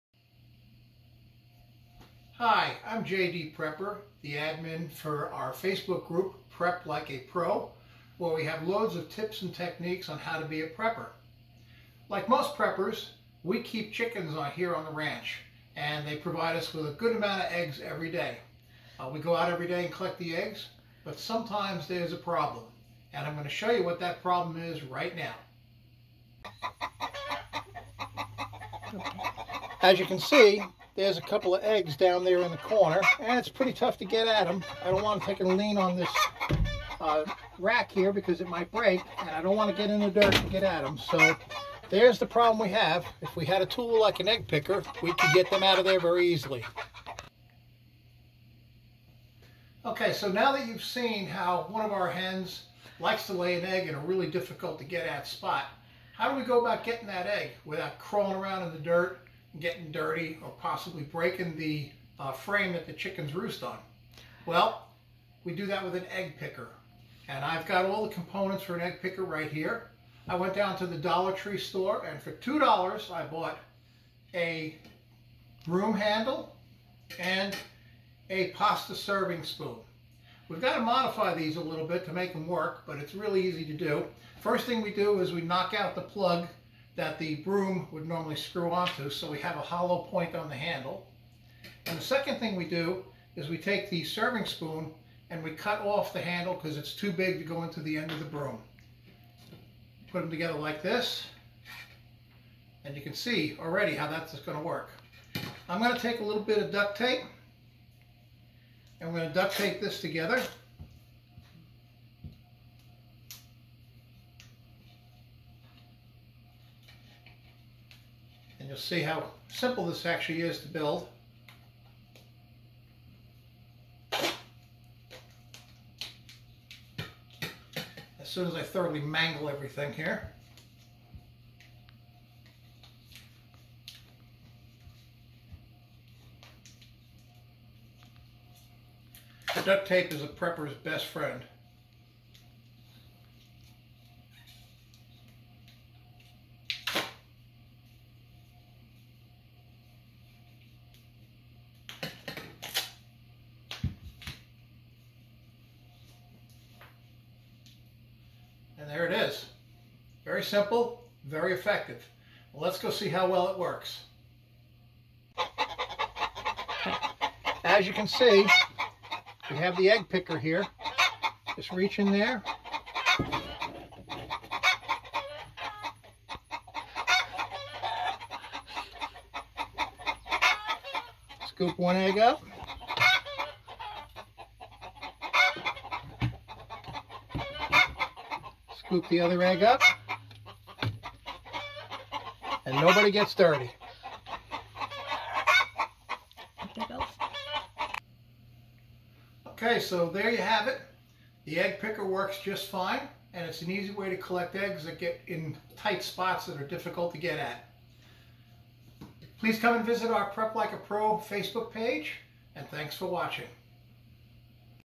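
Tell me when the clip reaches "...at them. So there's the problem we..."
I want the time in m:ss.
0:40.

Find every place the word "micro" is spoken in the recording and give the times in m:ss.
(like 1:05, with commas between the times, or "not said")
not said.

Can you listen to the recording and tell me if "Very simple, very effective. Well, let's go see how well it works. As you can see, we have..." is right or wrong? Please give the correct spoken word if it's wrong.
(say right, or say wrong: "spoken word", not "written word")
right.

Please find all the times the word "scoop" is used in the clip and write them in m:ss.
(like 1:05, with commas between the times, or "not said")
3:01, 3:08.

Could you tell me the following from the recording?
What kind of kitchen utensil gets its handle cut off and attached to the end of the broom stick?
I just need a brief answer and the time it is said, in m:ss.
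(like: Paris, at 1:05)
Pasta serving spoon, at 1:18.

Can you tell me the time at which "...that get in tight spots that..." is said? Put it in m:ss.
3:24.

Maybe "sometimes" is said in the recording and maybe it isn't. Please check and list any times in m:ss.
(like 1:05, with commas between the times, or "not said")
0:21.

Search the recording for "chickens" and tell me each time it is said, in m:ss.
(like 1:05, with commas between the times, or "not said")
0:13, 1:02.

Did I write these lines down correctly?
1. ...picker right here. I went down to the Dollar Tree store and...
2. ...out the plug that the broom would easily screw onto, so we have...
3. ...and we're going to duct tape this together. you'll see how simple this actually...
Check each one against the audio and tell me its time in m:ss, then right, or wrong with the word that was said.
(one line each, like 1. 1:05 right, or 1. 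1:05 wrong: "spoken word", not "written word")
1. 1:09 right
2. 1:25 wrong: "normally", not "easily"
3. 1:48 right.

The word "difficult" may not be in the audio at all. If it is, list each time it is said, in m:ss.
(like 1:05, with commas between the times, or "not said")
0:54, 3:26.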